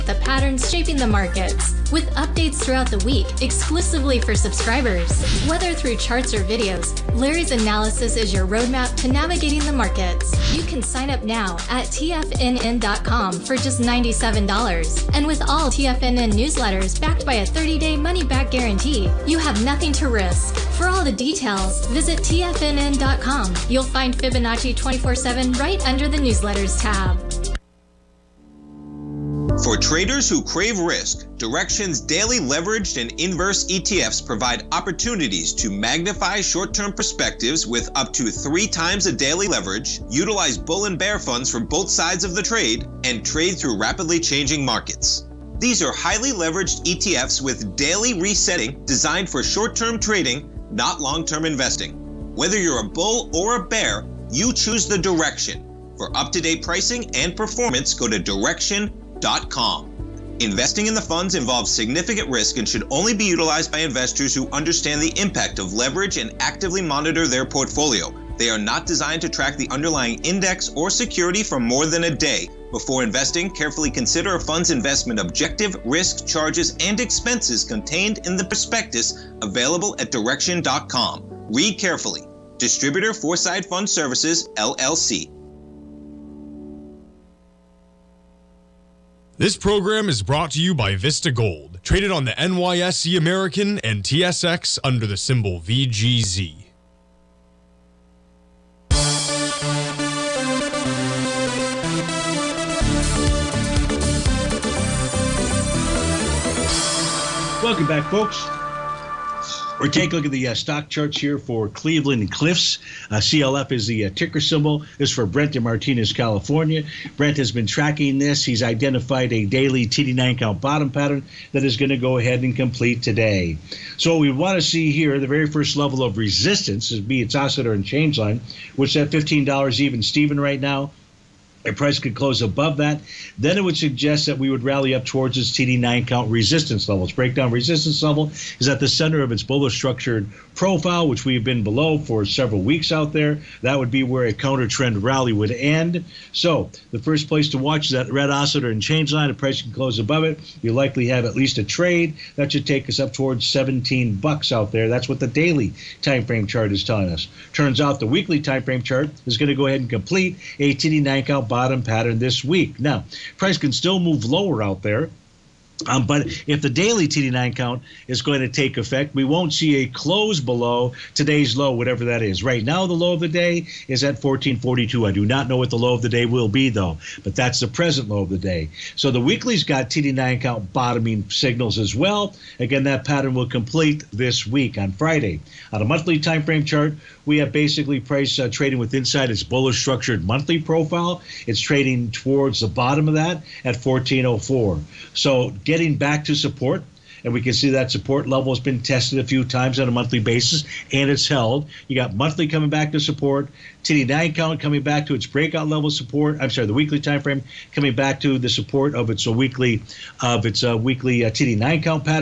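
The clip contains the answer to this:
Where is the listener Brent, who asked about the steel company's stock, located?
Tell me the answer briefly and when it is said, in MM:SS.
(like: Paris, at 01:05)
Martinez, California, at 01:55.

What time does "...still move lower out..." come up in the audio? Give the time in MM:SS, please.
02:43.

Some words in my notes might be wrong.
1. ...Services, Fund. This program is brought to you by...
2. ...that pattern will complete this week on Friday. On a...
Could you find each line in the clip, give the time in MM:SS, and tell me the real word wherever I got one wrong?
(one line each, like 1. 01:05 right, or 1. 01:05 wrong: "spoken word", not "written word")
1. 01:23 wrong: "LLC", not "Fund"
2. 03:02 right.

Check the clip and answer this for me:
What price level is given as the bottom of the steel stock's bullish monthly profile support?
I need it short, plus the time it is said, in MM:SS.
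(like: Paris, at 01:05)
14.04, at 03:13.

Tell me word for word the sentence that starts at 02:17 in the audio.
Its breakdown resistance level is at the center of its bullish structured profile, which we've been below for several weeks out there.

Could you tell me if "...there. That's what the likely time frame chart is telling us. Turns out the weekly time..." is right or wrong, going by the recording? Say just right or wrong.
wrong.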